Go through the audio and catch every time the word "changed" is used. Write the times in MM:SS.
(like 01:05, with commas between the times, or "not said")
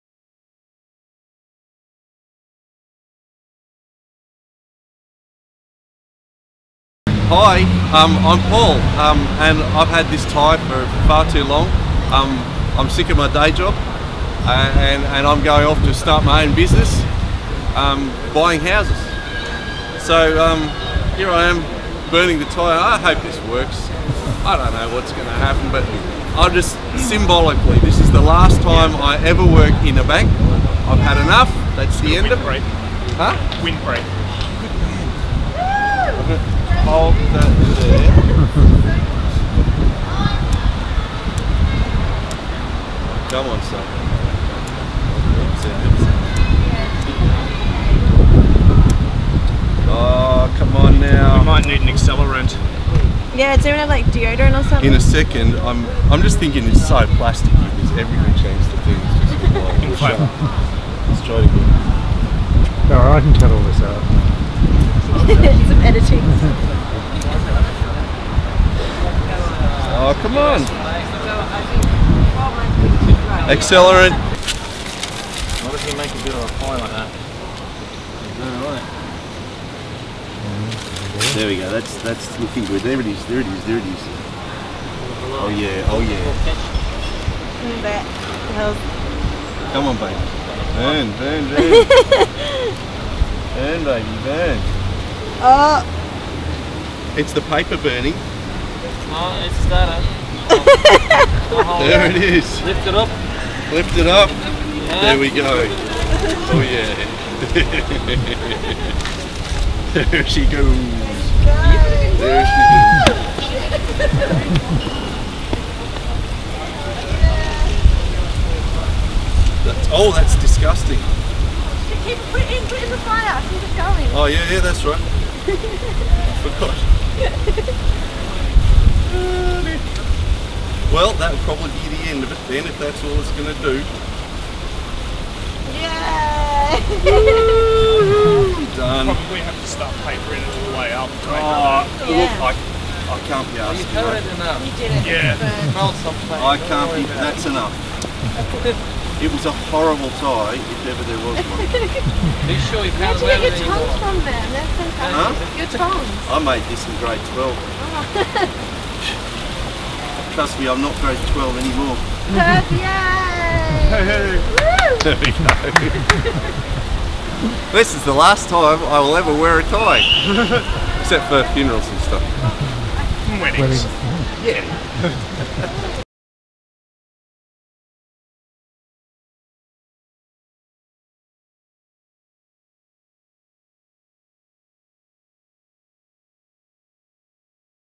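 00:58.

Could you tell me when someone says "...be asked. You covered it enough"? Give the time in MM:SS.
02:23.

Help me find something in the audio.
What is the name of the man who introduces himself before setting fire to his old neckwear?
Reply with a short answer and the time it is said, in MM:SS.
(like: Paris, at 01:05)
Paul, at 00:08.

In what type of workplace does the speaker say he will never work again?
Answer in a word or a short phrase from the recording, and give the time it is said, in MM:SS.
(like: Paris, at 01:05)
a bank, at 00:30.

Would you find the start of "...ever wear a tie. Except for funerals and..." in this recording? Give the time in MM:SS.
02:49.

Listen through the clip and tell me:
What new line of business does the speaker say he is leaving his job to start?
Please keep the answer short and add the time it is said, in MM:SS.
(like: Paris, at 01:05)
buying houses, at 00:18.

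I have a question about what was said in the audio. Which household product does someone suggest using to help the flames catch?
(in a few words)
deodorant.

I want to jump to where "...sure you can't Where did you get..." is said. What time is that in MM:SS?
02:32.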